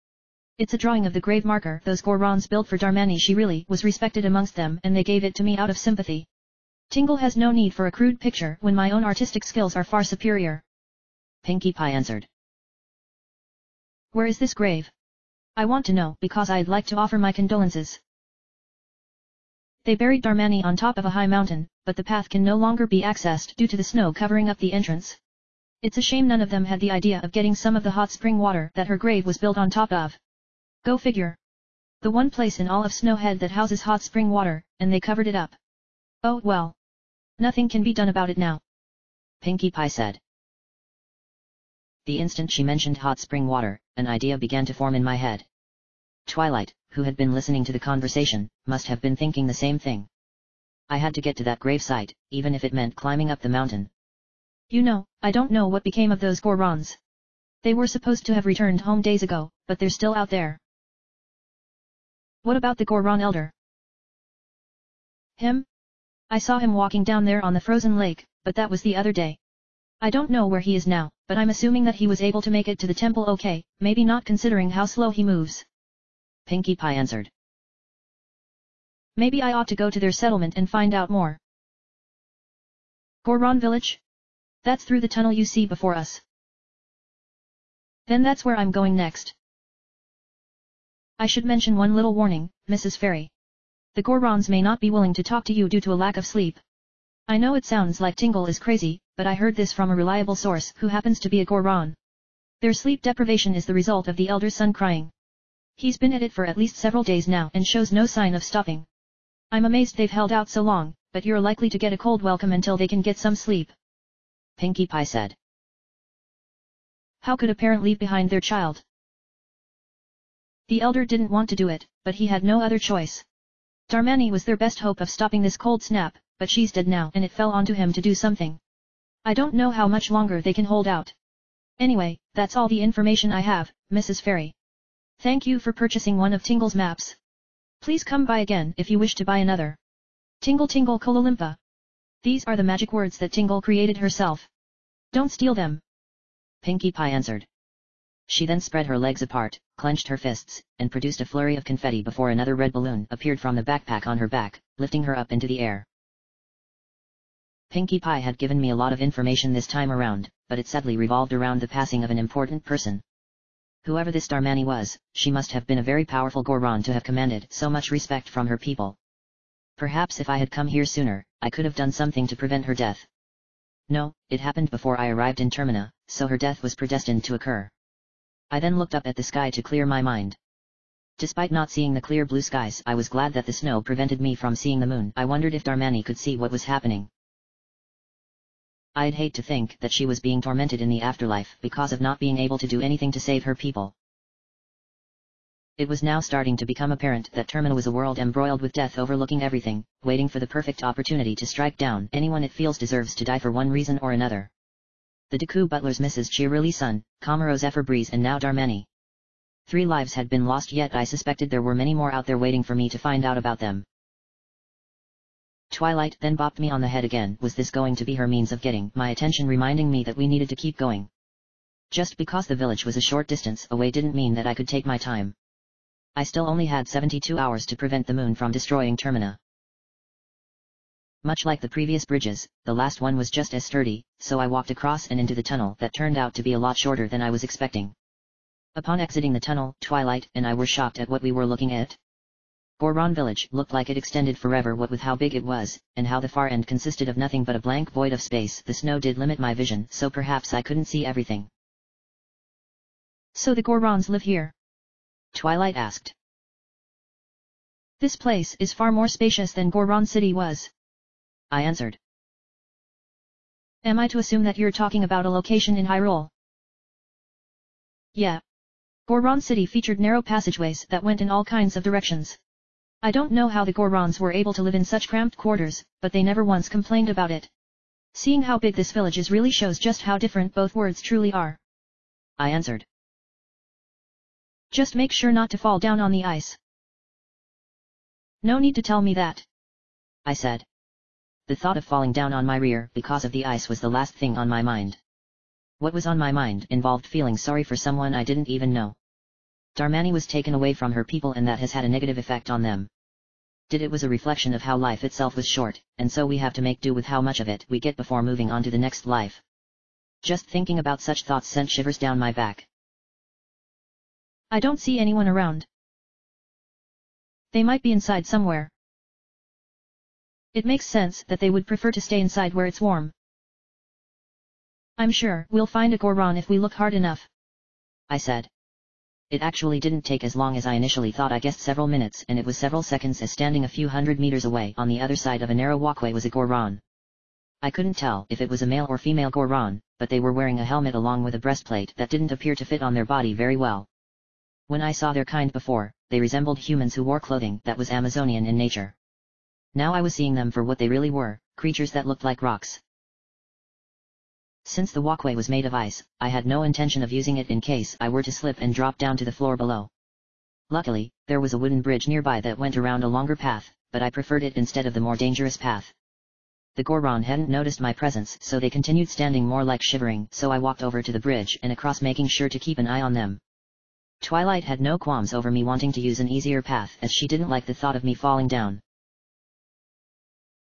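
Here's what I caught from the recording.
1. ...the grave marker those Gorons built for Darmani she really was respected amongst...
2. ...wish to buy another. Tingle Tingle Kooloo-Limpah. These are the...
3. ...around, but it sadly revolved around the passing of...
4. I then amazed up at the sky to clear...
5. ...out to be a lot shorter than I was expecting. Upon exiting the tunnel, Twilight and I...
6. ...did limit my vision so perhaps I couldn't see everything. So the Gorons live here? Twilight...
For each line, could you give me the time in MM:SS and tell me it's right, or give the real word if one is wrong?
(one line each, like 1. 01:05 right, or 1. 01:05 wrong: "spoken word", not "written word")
1. 00:01 right
2. 02:18 right
3. 02:39 right
4. 02:58 wrong: "looked", not "amazed"
5. 03:56 right
6. 04:08 right.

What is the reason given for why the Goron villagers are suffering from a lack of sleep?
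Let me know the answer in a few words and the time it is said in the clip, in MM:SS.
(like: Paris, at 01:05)
The Elder's son crying, at 01:44.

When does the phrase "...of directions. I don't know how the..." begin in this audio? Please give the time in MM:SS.
04:31.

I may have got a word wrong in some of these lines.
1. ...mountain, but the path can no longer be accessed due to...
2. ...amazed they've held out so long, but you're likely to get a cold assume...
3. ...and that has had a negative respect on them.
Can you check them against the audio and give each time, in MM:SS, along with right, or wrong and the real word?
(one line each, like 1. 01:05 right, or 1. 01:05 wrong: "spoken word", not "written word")
1. 00:21 right
2. 01:49 wrong: "welcome", not "assume"
3. 05:01 wrong: "effect", not "respect".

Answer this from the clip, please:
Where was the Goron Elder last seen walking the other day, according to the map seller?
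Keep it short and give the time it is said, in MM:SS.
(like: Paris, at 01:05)
The frozen lake, at 01:07.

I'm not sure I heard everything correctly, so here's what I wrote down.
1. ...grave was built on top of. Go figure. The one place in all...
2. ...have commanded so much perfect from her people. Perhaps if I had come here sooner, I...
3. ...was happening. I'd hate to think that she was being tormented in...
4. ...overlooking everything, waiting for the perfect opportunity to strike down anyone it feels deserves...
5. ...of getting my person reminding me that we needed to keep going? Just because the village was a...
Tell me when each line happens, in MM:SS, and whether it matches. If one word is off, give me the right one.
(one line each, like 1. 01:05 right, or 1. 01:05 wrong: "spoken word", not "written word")
1. 00:28 right
2. 02:46 wrong: "respect", not "perfect"
3. 03:06 right
4. 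03:18 right
5. 03:38 wrong: "attention", not "person".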